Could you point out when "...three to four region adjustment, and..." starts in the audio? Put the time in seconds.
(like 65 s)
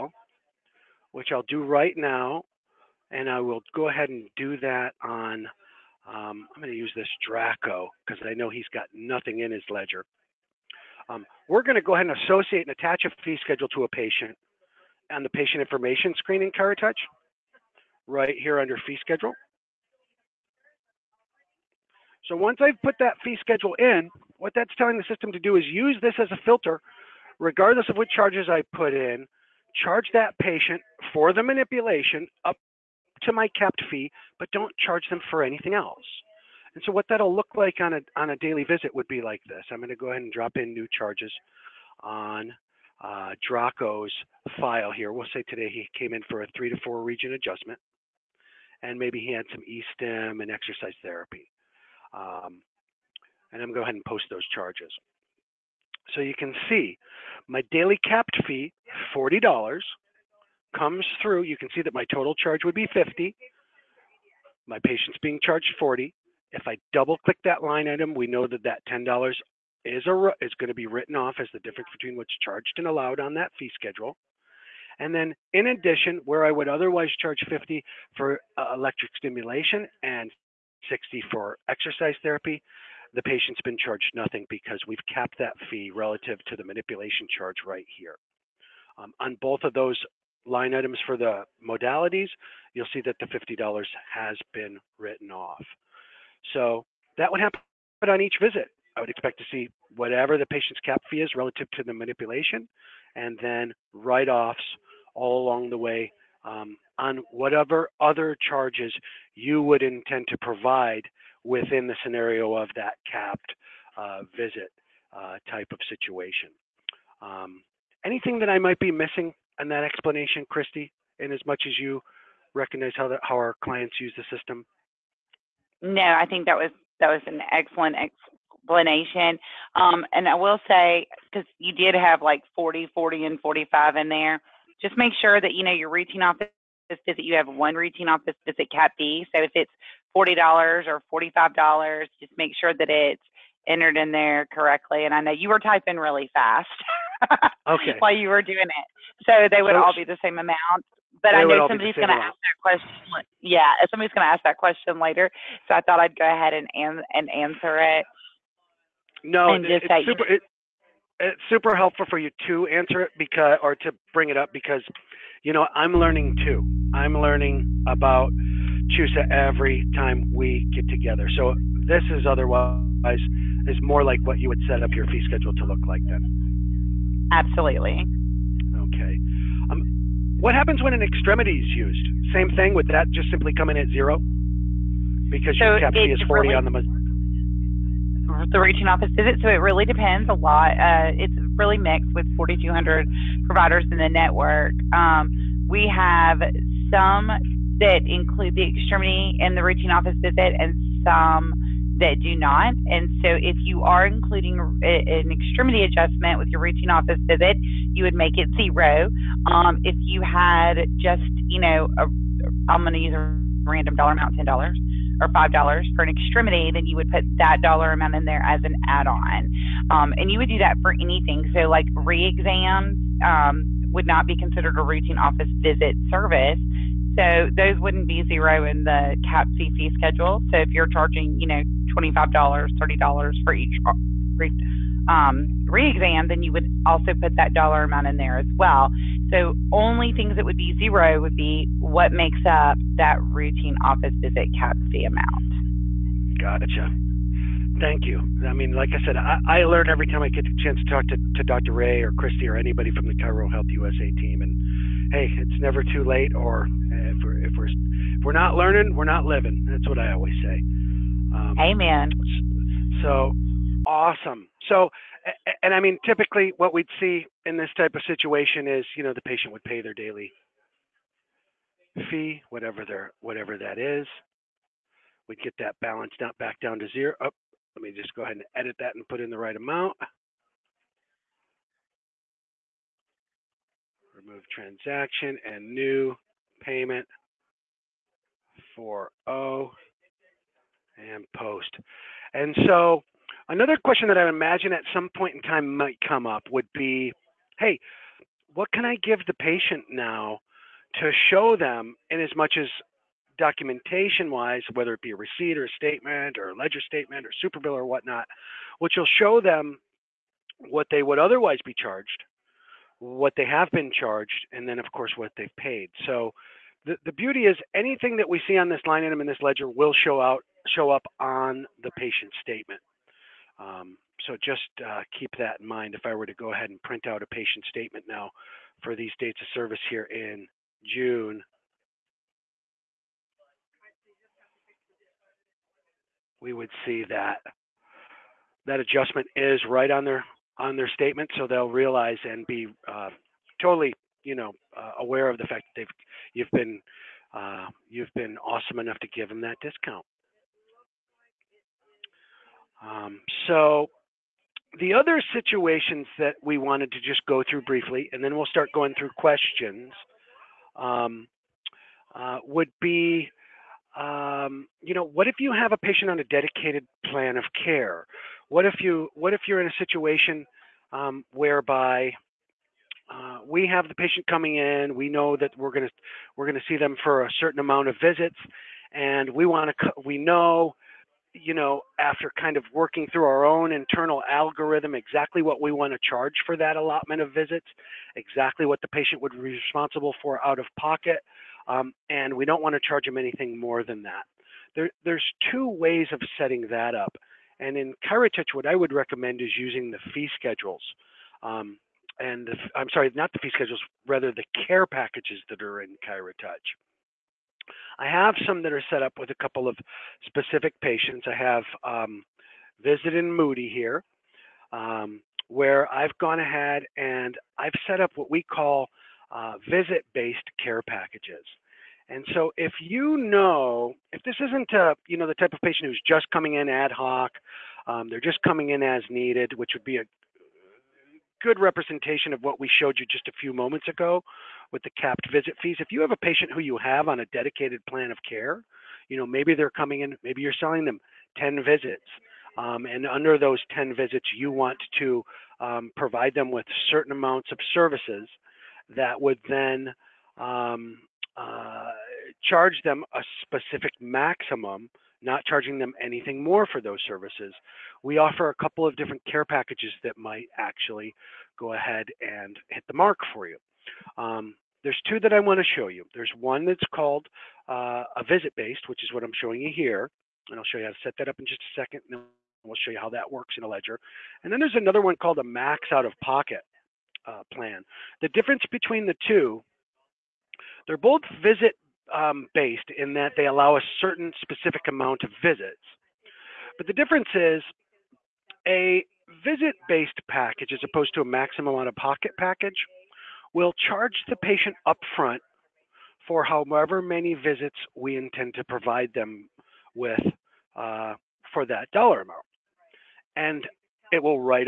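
46 s.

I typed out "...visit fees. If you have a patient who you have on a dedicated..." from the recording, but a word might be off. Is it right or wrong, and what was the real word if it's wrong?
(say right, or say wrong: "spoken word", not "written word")
right.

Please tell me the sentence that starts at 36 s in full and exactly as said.
And so what that'll look like on a, on a daily visit would be like this.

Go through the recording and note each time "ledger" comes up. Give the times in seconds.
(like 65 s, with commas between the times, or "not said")
9 s, 306 s, 319 s, 473 s.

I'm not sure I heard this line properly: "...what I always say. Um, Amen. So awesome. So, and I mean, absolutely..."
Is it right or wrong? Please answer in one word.
wrong.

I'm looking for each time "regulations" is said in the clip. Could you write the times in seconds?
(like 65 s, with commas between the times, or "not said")
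not said.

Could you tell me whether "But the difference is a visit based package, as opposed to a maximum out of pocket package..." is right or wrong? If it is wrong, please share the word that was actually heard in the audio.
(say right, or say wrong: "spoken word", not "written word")
right.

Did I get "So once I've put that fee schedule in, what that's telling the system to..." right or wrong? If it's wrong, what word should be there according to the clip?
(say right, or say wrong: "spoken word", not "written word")
right.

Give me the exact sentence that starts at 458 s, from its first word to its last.
We offer a couple of different care packages that might actually go ahead and hit the mark for you.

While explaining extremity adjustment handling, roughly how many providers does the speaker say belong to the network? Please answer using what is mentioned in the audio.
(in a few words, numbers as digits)
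4,200.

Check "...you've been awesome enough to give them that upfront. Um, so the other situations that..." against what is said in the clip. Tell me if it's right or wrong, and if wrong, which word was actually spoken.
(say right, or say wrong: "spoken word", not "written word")
wrong: "discount", not "upfront".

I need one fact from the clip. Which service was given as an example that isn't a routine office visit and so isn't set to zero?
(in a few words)
re-exams.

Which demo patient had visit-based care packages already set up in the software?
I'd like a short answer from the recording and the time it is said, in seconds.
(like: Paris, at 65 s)
Moody, at 413 s.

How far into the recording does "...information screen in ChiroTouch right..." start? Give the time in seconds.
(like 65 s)
15 s.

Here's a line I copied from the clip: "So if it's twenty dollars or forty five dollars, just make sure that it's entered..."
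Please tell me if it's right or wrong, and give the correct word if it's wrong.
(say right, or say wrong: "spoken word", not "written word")
wrong: "forty", not "twenty".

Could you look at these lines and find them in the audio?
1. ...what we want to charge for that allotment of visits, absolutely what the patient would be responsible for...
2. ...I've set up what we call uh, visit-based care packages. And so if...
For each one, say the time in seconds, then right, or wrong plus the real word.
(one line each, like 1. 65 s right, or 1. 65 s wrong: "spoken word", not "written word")
1. 385 s wrong: "exactly", not "absolutely"
2. 417 s right.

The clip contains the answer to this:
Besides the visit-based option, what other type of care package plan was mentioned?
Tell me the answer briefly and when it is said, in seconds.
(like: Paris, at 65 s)
max out of pocket, at 475 s.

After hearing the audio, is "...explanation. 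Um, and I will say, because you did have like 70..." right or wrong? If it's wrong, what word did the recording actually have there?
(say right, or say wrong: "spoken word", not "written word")
wrong: "40", not "70".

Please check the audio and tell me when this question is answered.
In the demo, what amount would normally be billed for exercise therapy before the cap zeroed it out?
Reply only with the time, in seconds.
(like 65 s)
80 s.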